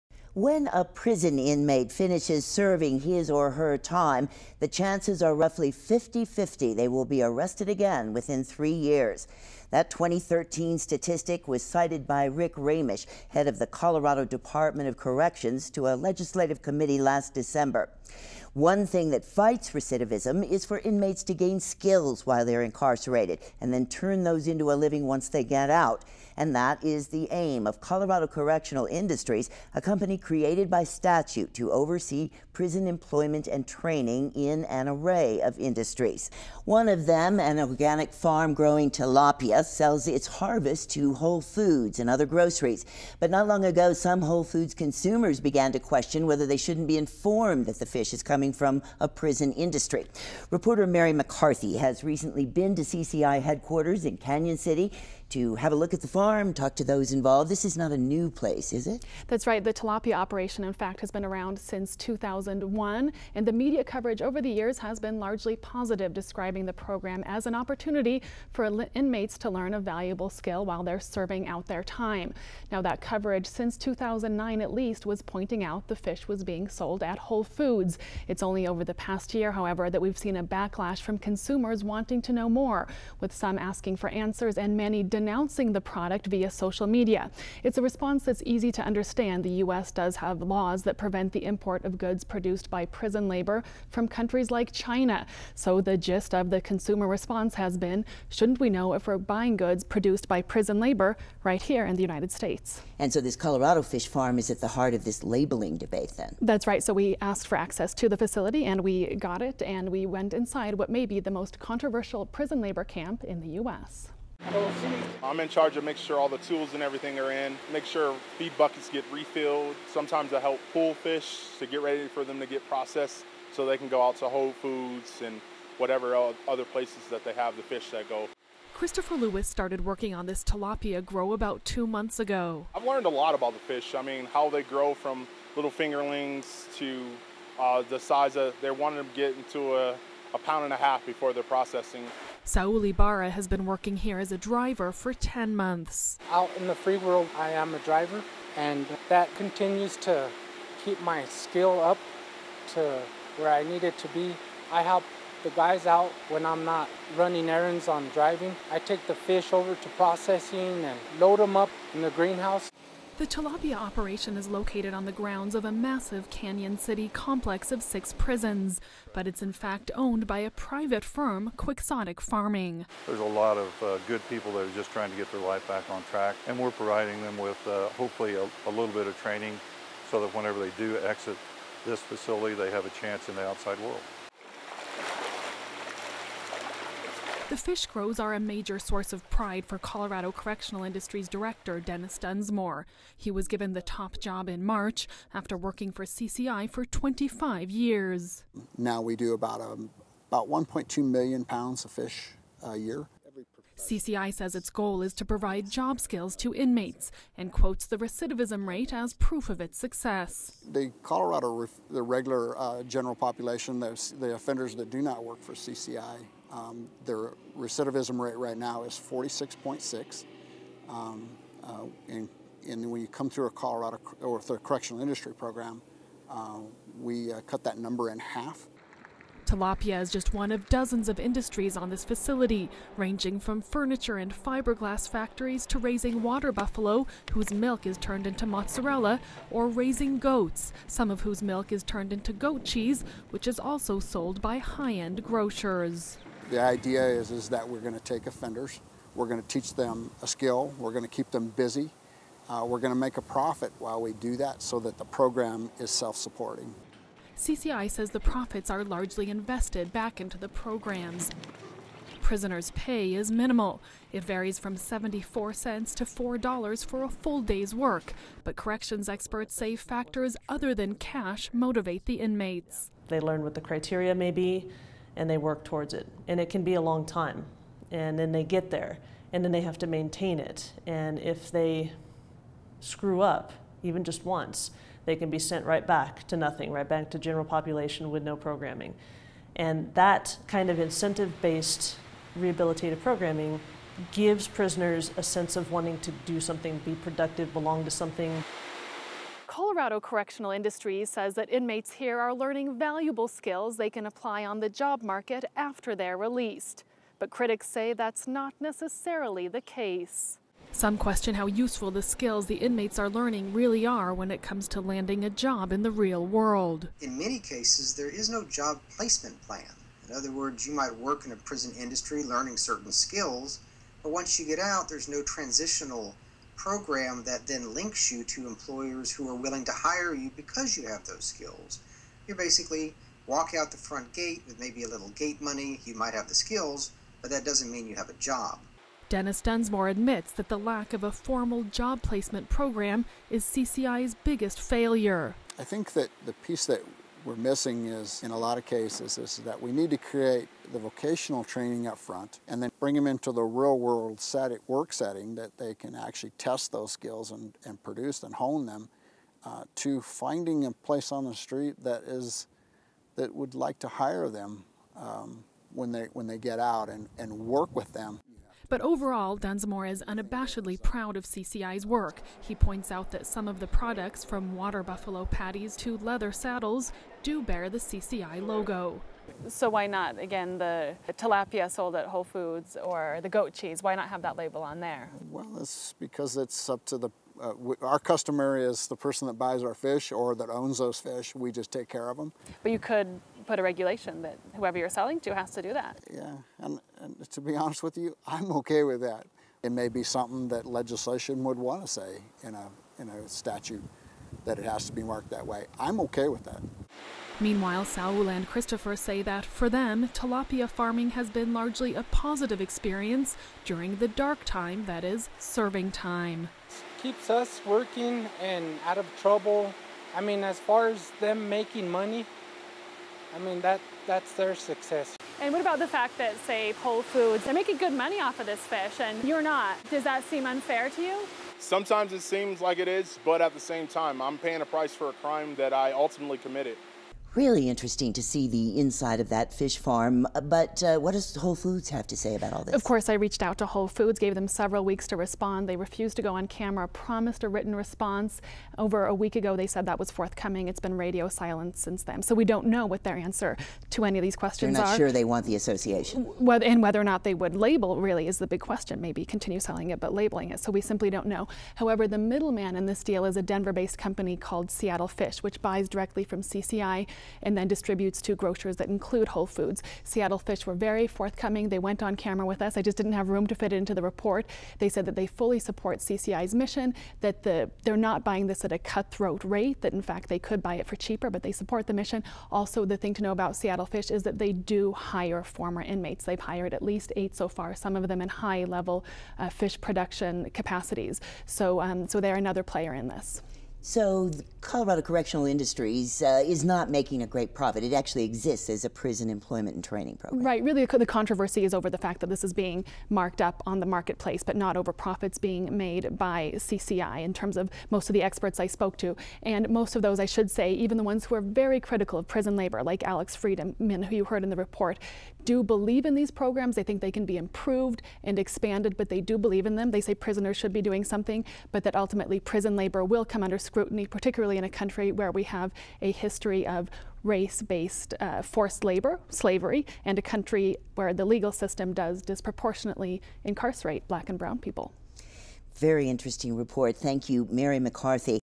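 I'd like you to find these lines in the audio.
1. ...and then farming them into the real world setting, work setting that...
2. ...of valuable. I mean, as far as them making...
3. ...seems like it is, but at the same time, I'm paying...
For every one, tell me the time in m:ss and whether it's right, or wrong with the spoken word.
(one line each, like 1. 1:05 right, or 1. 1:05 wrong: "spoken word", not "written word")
1. 5:52 wrong: "bring", not "farming"
2. 6:58 wrong: "trouble", not "valuable"
3. 7:12 right.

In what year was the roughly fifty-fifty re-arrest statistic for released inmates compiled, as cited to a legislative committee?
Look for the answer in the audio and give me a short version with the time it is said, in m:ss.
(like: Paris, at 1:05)
2013, at 0:09.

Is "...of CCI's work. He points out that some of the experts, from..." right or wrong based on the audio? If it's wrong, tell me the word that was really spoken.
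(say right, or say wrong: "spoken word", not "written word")
wrong: "products", not "experts".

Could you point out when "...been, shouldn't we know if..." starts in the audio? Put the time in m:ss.
1:37.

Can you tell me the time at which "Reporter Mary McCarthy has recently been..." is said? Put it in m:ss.
0:50.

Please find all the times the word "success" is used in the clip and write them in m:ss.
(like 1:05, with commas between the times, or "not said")
3:29, 7:04.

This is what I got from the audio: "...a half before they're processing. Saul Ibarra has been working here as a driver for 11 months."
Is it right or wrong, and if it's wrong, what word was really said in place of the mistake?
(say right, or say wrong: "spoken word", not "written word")
wrong: "10", not "11".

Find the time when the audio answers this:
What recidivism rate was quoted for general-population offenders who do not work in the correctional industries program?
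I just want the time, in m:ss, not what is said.
3:38.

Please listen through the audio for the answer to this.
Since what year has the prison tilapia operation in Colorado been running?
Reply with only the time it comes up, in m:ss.
1:01.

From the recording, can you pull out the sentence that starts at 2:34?
I help the guys out when I'm not running errands on driving.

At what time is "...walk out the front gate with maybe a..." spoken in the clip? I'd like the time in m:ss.
5:33.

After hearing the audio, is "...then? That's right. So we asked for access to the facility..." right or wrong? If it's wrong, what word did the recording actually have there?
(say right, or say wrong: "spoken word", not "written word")
right.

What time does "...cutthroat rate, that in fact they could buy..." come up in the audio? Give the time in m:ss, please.
7:58.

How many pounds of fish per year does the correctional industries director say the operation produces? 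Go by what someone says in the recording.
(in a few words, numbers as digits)
1.2 million pounds.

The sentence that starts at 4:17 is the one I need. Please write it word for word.
CCI says the profits are largely invested back into the programs.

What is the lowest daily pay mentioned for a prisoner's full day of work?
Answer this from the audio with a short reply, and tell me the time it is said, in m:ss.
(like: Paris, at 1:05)
74 cents, at 4:24.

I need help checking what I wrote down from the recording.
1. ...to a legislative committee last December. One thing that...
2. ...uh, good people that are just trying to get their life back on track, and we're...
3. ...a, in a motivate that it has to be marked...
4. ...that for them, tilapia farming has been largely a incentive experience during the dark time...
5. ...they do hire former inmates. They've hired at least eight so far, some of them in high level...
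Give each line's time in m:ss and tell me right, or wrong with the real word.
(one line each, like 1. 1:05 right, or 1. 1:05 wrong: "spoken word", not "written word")
1. 0:15 right
2. 2:53 right
3. 6:42 wrong: "statute", not "motivate"
4. 6:49 wrong: "positive", not "incentive"
5. 8:04 right.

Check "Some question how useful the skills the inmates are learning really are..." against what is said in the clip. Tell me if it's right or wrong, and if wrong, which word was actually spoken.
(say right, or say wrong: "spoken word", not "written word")
right.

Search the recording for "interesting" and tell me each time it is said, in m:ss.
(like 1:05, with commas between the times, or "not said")
7:17, 8:56.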